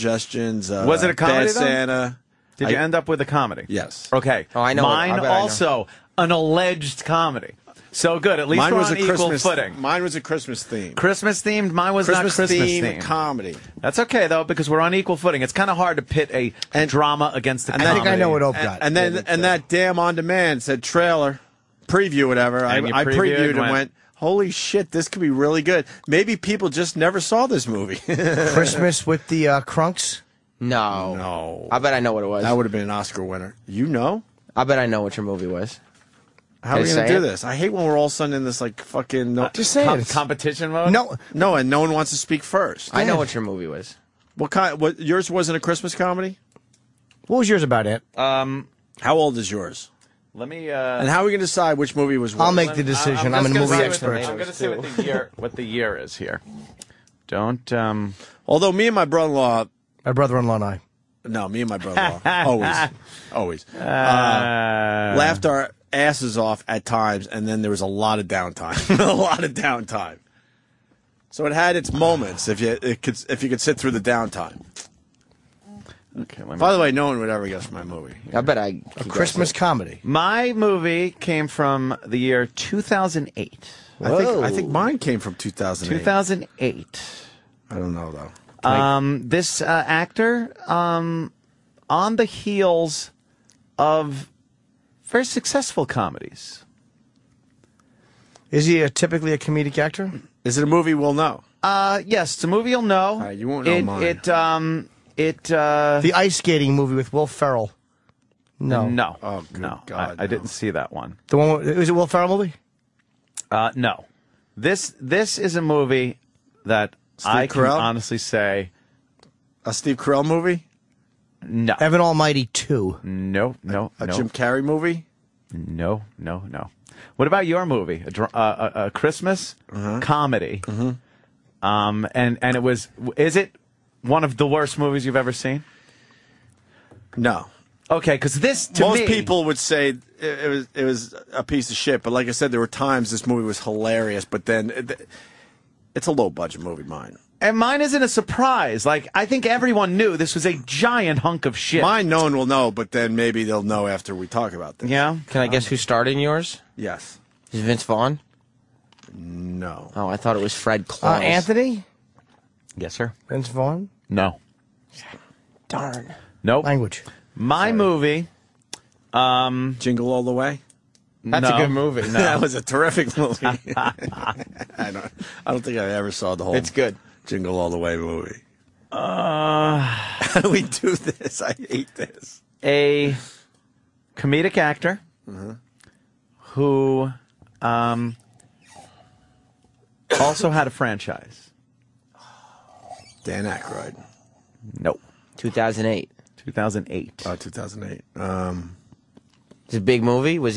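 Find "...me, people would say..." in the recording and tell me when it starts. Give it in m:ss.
2:18.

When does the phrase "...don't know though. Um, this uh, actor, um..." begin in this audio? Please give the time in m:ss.
1:27.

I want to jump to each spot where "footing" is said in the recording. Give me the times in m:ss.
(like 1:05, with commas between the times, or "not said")
0:09, 0:15.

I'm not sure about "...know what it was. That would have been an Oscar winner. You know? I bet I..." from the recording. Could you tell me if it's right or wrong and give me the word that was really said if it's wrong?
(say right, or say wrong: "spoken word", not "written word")
right.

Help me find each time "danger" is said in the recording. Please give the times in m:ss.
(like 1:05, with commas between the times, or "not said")
not said.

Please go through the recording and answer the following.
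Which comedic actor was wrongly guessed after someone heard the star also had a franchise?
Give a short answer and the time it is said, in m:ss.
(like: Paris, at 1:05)
Dan Aykroyd, at 3:13.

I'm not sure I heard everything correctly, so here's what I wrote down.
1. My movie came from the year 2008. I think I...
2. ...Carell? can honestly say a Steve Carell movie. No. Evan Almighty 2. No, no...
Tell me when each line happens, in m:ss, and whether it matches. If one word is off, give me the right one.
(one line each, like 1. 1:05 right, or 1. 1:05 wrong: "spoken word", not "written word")
1. 1:20 right
2. 1:57 right.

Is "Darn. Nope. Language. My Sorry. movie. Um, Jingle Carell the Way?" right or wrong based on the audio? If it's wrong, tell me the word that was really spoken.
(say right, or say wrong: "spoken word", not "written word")
wrong: "All", not "Carell".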